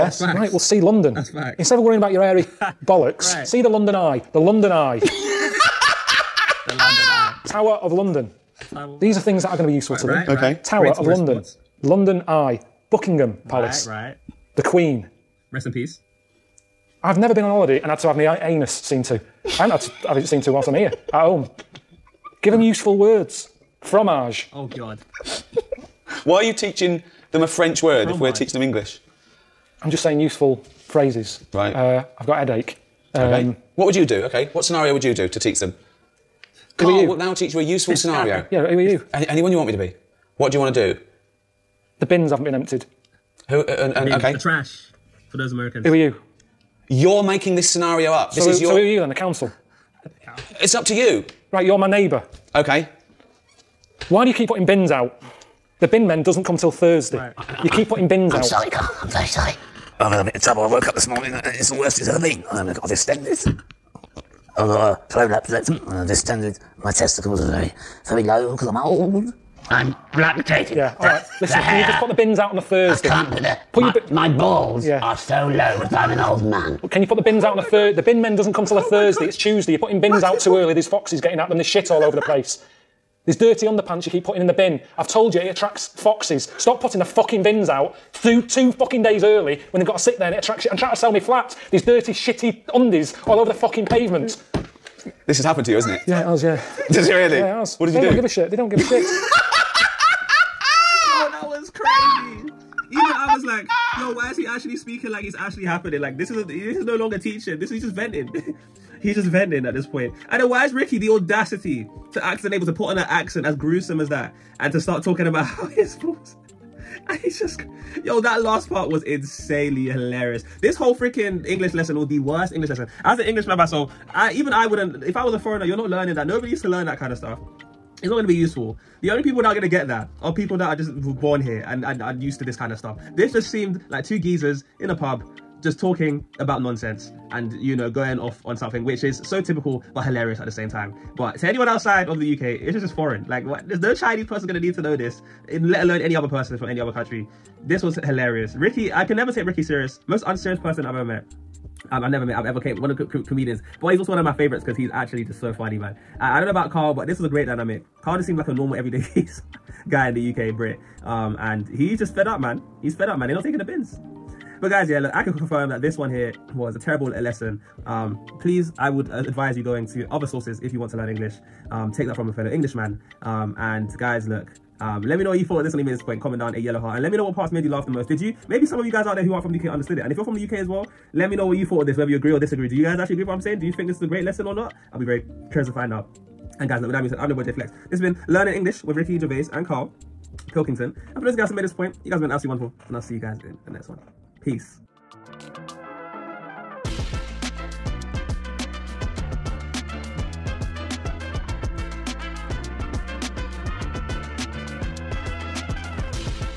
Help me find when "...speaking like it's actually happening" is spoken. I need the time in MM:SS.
01:44.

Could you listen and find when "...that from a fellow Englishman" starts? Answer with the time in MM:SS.
02:52.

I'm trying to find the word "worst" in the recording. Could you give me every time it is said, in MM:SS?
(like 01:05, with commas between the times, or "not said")
01:01, 02:02.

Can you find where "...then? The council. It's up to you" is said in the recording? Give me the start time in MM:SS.
00:48.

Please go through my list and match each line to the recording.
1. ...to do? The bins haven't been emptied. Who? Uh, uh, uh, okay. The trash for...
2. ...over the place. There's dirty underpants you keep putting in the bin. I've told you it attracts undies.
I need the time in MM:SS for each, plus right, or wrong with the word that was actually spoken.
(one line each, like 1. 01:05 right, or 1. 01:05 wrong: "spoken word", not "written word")
1. 00:40 right
2. 01:22 wrong: "foxes", not "undies".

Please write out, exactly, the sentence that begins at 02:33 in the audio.
But he's also one of my favorites because he's actually just so funny, man.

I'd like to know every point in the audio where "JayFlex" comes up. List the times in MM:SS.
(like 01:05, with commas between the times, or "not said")
03:07.